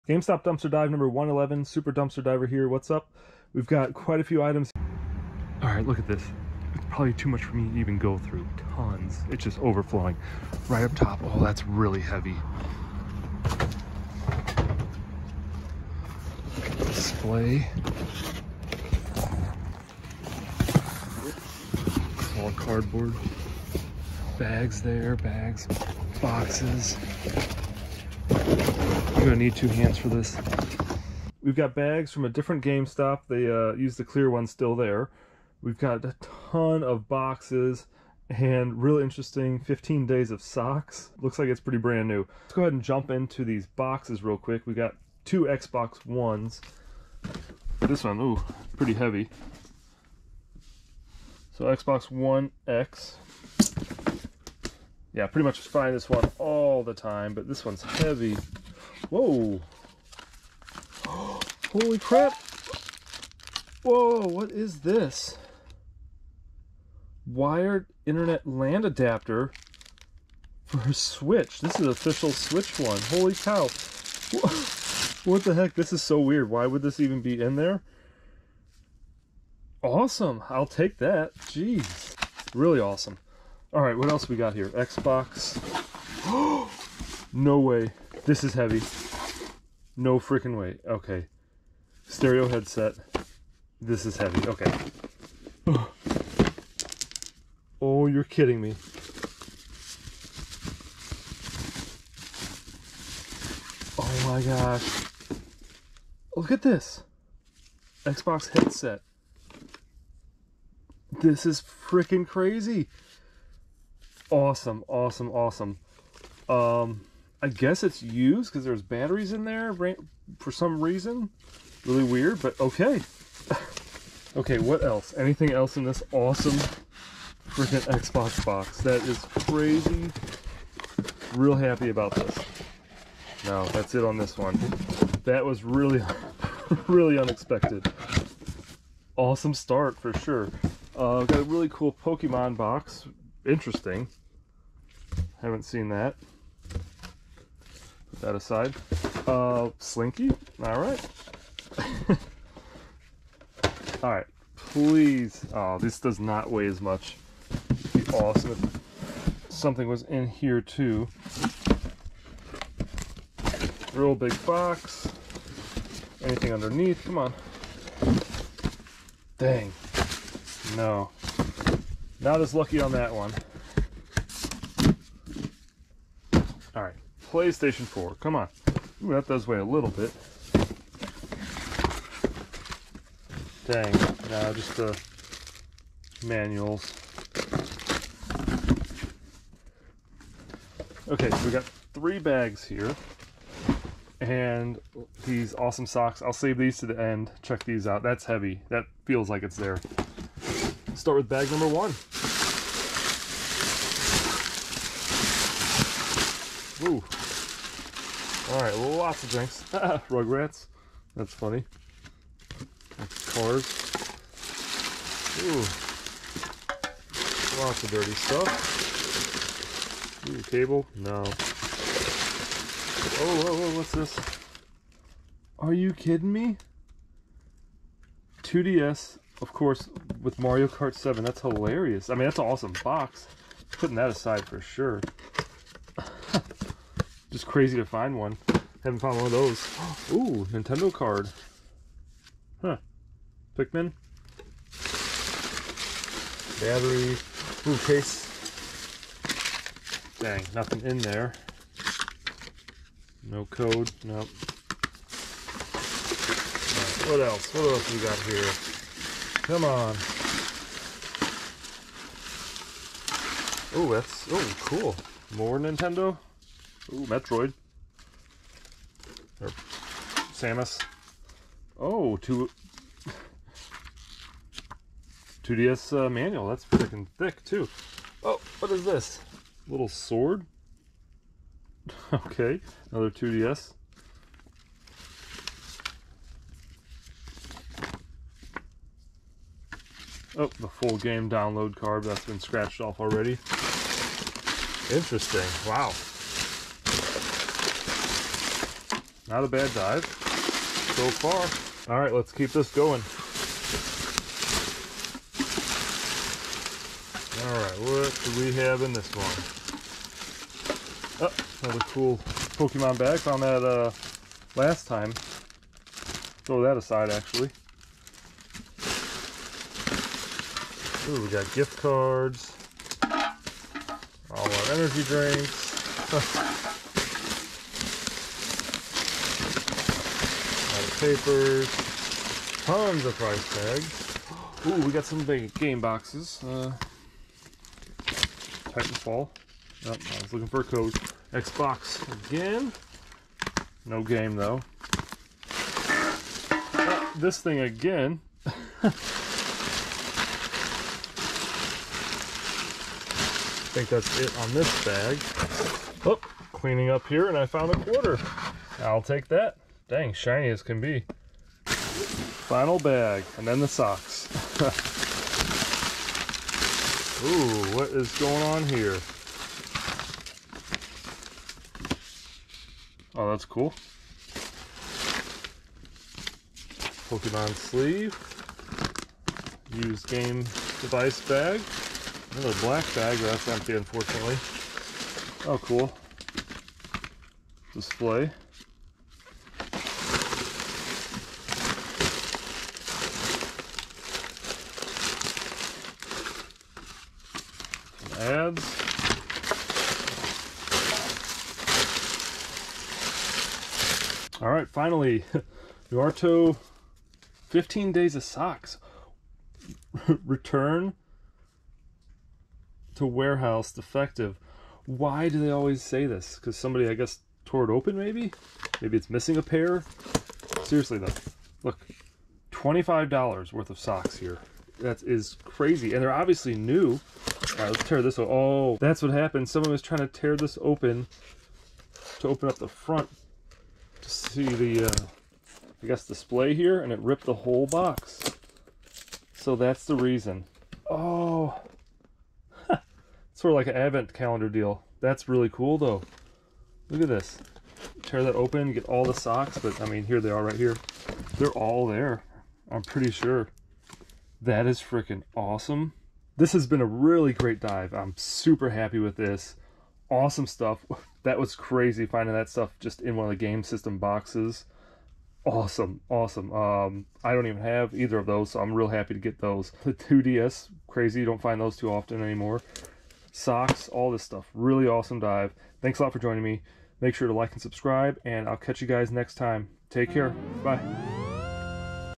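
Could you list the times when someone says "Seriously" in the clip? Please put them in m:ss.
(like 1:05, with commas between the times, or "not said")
7:00.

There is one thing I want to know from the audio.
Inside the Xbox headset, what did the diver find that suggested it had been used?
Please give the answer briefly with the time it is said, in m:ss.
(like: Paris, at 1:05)
batteries, at 1:58.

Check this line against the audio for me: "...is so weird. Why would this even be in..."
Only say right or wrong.
right.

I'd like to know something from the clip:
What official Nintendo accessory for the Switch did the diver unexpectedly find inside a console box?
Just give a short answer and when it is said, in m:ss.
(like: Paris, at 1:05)
Wired internet LAN adapter, at 1:07.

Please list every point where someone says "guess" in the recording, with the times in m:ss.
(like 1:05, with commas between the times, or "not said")
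1:57, 6:56, 7:15.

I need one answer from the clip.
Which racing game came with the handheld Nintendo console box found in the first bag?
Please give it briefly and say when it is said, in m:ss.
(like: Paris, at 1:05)
Mario Kart 7, at 3:50.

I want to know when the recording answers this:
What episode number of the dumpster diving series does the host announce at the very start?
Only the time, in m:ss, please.
0:00.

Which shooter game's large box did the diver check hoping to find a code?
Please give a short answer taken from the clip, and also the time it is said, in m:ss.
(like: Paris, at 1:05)
Titanfall, at 5:38.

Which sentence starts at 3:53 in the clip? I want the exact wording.
Putting that aside for sure just crazy to find one.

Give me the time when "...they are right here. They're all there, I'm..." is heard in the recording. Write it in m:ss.
7:30.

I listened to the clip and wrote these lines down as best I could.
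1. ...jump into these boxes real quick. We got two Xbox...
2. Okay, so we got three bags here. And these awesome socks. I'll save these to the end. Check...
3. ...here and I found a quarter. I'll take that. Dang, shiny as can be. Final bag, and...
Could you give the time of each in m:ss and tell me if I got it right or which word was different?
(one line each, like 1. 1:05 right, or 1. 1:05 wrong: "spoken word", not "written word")
1. 0:42 right
2. 3:11 right
3. 5:57 right.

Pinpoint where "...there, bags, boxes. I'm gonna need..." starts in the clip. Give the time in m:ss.
0:24.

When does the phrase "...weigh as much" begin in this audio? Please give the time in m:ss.
2:36.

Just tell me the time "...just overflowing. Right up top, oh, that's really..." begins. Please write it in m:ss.
0:09.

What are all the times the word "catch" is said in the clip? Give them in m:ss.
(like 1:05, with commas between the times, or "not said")
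7:58.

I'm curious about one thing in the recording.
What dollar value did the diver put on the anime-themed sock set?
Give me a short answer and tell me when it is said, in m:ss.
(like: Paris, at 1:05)
$25, at 7:02.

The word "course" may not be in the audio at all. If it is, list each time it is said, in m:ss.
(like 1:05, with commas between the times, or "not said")
3:49.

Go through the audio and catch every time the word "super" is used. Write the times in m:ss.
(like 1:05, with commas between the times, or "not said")
0:01, 7:38.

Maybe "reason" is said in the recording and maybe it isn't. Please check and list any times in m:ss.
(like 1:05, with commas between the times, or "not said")
2:00, 7:19.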